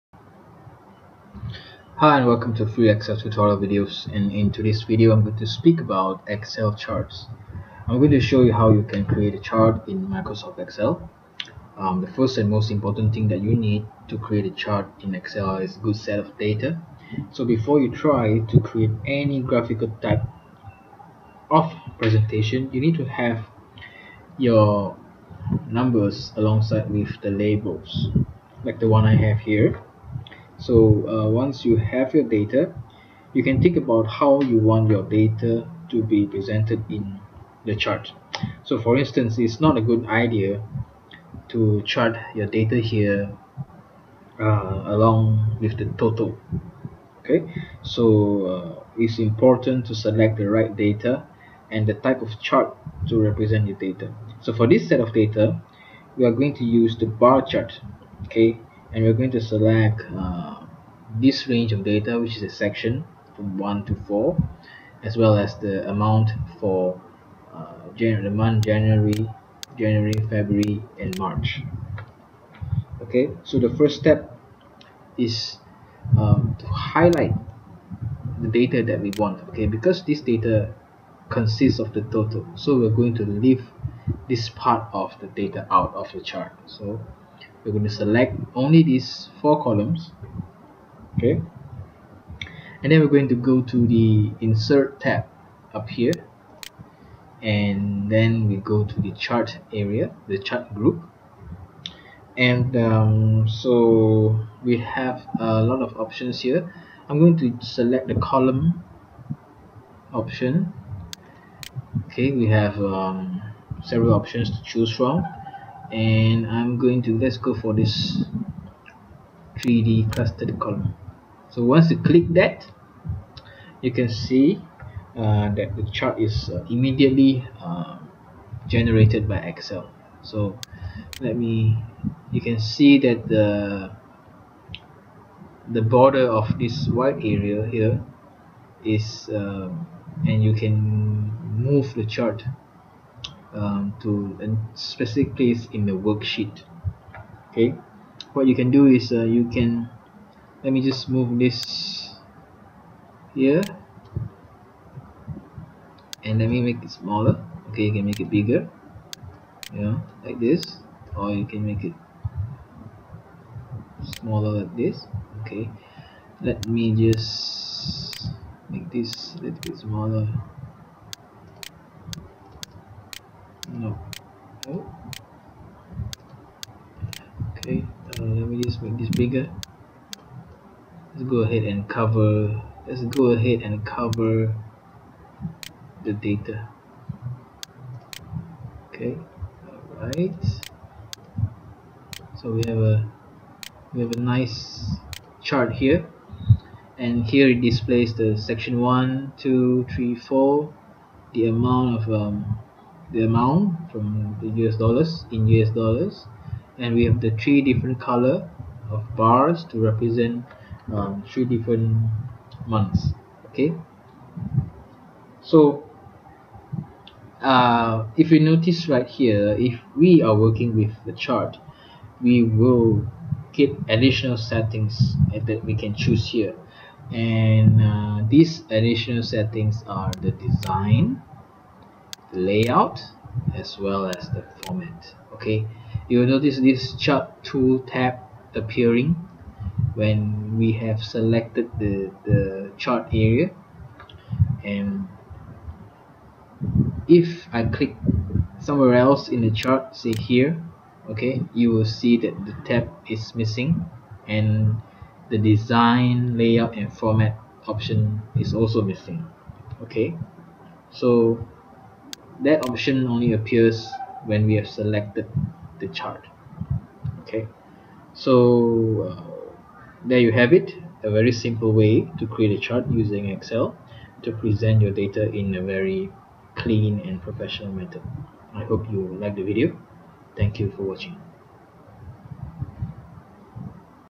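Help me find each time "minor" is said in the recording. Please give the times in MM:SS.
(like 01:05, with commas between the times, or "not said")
not said.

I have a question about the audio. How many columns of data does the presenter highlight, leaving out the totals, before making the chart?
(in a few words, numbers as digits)
4.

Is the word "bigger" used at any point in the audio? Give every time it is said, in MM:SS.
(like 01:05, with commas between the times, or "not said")
02:38, 02:59.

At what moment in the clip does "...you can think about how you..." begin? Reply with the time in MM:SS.
00:33.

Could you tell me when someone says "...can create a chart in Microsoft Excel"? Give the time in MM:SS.
00:08.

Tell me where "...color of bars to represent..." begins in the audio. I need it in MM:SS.
03:27.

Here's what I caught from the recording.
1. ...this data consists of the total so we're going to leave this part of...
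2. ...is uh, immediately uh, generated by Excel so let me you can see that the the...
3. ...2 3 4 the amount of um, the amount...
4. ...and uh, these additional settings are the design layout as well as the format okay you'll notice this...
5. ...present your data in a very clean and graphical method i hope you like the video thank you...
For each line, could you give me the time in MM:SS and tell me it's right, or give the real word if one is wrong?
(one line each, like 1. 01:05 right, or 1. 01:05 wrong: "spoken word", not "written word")
1. 01:20 right
2. 02:06 right
3. 03:19 right
4. 03:47 right
5. 04:34 wrong: "professional", not "graphical".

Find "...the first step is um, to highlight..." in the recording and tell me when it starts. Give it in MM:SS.
01:13.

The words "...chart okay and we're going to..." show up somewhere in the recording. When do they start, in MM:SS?
00:57.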